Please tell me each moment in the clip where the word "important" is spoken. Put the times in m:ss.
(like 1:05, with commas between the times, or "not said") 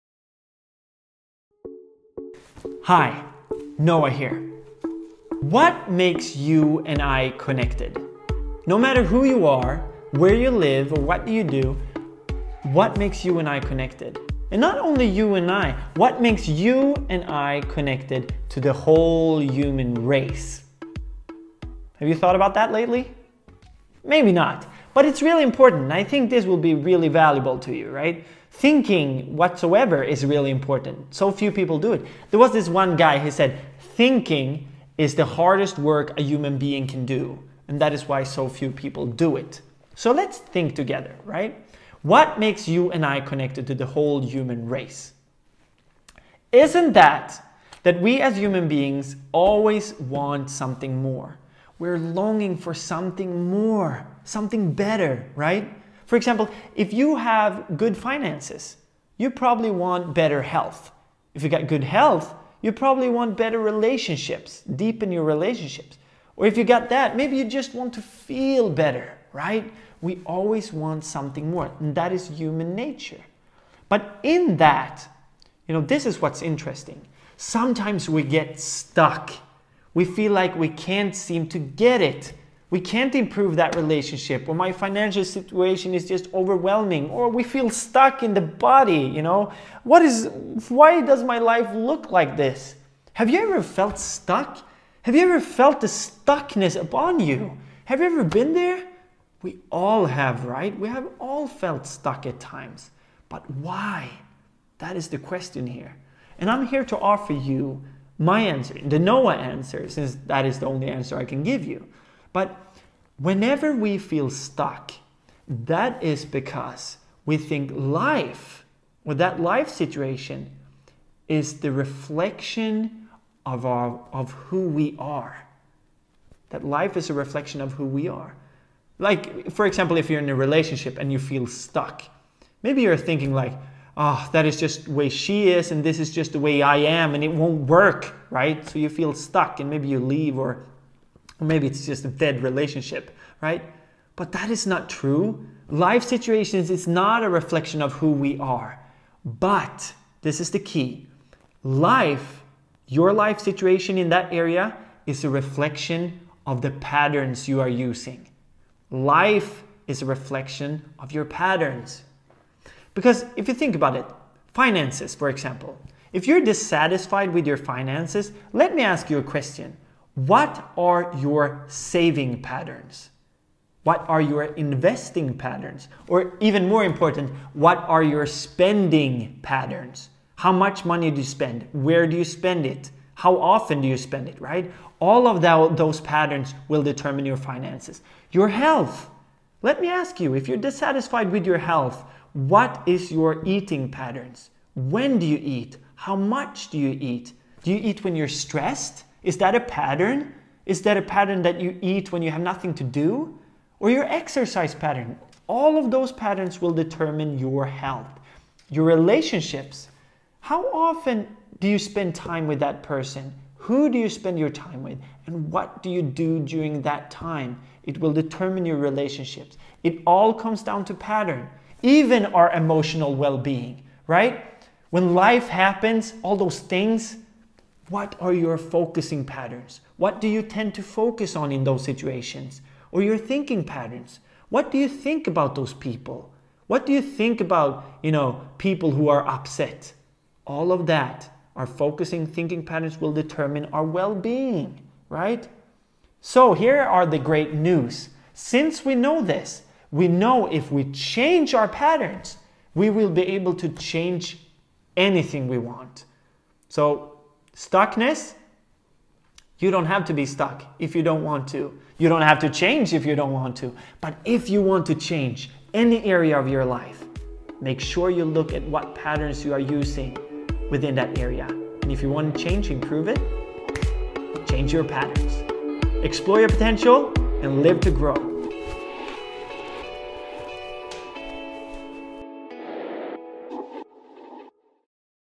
0:25, 0:30, 2:56.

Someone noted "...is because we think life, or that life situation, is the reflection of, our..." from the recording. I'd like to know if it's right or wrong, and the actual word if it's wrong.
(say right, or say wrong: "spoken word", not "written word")
right.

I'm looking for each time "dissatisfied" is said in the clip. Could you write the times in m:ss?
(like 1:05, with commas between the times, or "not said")
2:46, 3:10.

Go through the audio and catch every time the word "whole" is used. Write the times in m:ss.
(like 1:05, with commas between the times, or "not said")
0:18, 0:43.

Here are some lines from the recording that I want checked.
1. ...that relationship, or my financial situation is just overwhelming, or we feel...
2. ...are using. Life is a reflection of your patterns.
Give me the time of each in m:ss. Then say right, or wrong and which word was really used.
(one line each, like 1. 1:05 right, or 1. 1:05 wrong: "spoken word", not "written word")
1. 1:23 right
2. 2:37 right.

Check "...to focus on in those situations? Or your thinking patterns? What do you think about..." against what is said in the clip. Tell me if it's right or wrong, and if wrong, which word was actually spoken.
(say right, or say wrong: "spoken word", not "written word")
right.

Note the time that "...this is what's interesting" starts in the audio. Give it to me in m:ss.
1:15.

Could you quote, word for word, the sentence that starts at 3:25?
All of those patterns will determine your health.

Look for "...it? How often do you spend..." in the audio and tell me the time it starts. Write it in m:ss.
3:02.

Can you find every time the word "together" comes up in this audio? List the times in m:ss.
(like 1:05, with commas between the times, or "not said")
0:40.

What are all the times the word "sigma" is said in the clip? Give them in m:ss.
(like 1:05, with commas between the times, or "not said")
not said.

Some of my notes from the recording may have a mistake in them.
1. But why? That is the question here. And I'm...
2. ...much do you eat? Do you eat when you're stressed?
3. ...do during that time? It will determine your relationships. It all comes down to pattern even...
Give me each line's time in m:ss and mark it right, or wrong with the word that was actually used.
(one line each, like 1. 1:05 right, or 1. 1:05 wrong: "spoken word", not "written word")
1. 1:43 right
2. 3:16 right
3. 3:36 right.